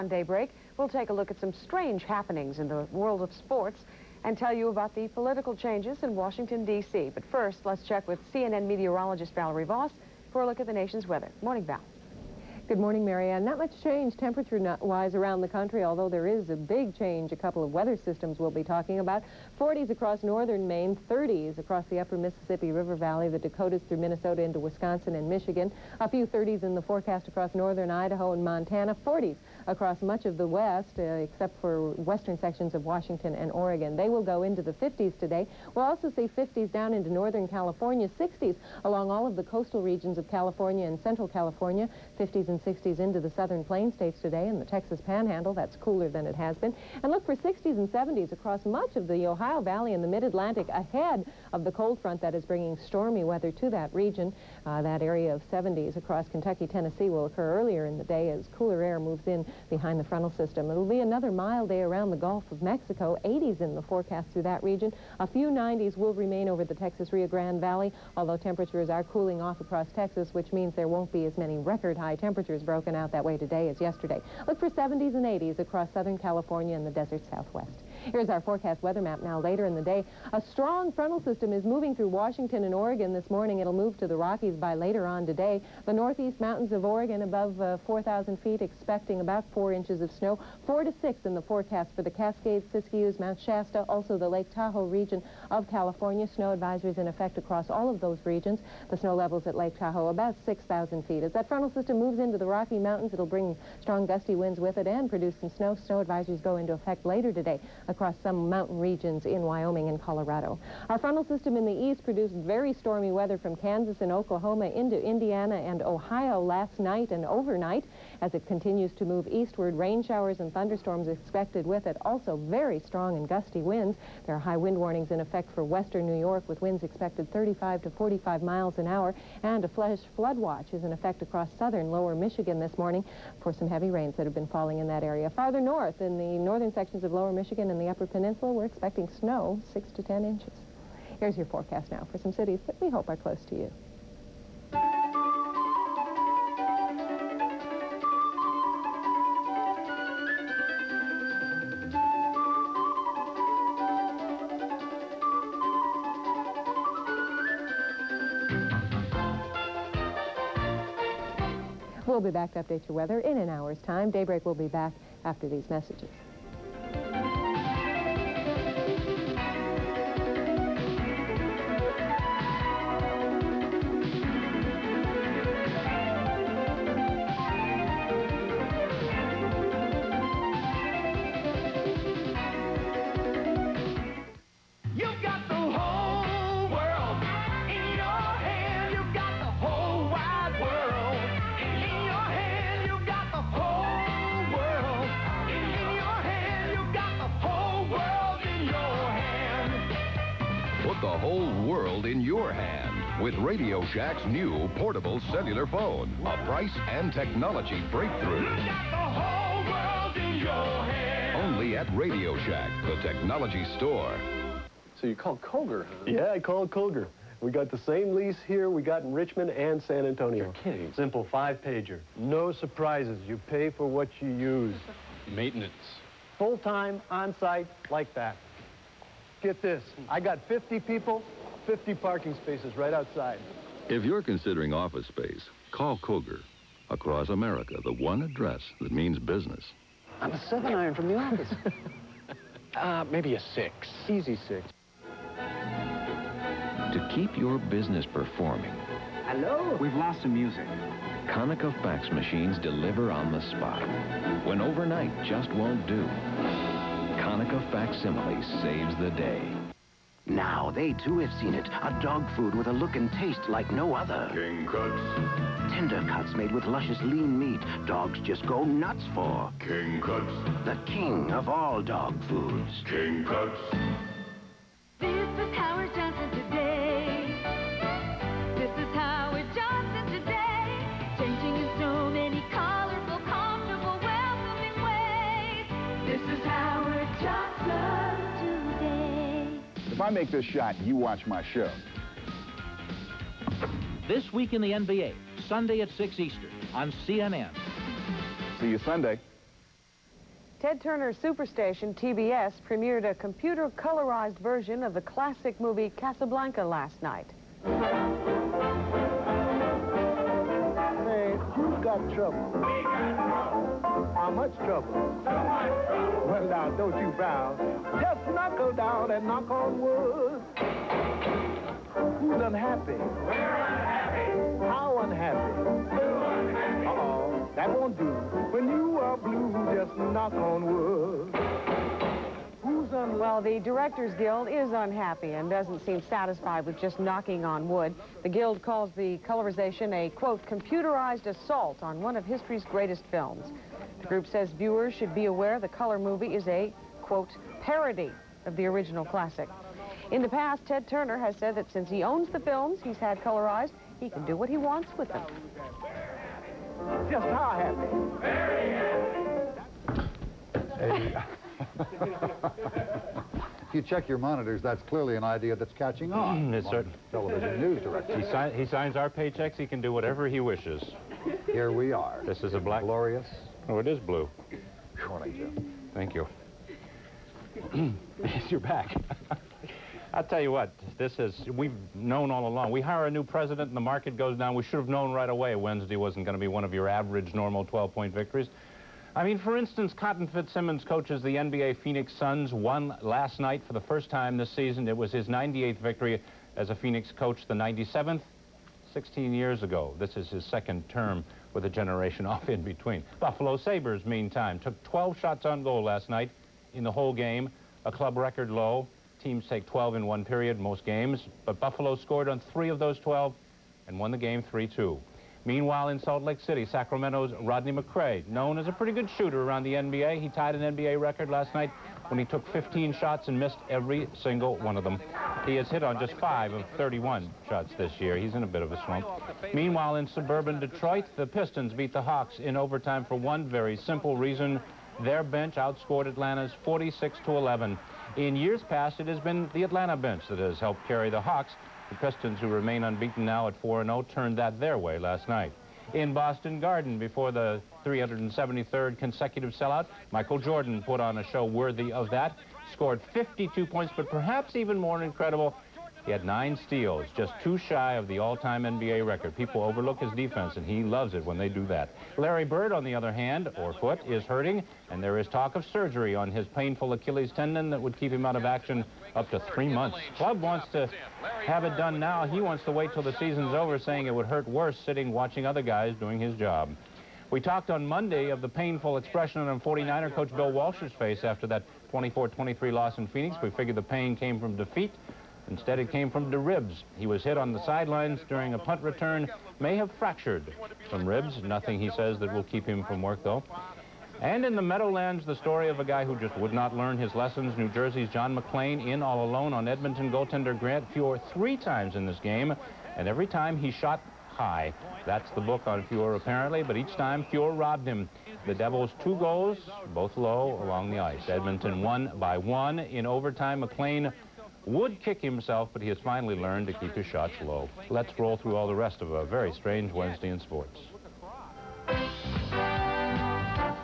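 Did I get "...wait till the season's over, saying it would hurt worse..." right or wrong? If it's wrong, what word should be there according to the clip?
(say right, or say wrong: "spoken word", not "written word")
right.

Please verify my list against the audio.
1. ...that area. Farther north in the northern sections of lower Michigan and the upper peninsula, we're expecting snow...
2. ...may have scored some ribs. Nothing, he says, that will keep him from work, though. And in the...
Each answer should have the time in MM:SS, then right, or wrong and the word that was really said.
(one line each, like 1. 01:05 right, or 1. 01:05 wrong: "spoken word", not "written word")
1. 02:14 right
2. 08:09 wrong: "fractured", not "scored".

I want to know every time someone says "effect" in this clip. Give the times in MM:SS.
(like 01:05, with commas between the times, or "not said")
01:37, 01:46, 02:05, 02:10.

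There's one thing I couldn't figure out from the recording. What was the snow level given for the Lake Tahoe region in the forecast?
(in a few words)
6,000 feet.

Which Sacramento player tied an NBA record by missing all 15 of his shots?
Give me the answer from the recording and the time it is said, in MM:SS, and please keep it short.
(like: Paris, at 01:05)
Rodney McCray, at 06:57.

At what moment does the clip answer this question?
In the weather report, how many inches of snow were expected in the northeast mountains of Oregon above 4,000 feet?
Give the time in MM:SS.
01:29.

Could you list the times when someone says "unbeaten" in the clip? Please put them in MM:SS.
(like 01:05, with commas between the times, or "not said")
07:22.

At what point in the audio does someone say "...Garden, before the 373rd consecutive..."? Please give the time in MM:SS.
07:26.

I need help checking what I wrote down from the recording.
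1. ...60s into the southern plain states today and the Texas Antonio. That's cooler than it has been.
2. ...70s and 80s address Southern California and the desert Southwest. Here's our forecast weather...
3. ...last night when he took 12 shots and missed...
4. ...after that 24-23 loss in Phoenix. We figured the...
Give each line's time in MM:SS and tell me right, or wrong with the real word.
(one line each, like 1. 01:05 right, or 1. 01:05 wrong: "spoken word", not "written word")
1. 00:42 wrong: "Panhandle", not "Antonio"
2. 01:14 wrong: "across", not "address"
3. 07:01 wrong: "15", not "12"
4. 08:01 right.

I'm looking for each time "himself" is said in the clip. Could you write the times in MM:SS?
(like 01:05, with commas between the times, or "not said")
08:35.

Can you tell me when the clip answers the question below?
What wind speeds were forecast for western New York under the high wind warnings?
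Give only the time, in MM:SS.
02:07.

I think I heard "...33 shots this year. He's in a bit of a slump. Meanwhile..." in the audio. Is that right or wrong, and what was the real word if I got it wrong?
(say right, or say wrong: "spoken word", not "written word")
wrong: "31", not "33".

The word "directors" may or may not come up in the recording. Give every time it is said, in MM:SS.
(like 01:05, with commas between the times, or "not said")
05:33, 06:07.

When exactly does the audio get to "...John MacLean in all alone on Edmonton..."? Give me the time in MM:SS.
08:18.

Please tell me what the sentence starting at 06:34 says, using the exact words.
It was his 98th victory as a Phoenix coach, the 97th, 16 years ago.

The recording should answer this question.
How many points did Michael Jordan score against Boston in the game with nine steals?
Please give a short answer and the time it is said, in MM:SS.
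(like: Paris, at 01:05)
52, at 07:33.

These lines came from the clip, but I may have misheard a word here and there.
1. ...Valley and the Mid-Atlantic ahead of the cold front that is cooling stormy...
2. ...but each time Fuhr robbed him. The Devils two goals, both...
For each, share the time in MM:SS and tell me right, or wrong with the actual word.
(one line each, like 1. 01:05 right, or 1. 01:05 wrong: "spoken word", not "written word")
1. 00:49 wrong: "bringing", not "cooling"
2. 08:26 right.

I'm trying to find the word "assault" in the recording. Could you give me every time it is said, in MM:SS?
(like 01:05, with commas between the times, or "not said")
05:41.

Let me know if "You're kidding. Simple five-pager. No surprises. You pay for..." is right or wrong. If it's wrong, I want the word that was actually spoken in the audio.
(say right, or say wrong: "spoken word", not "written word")
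right.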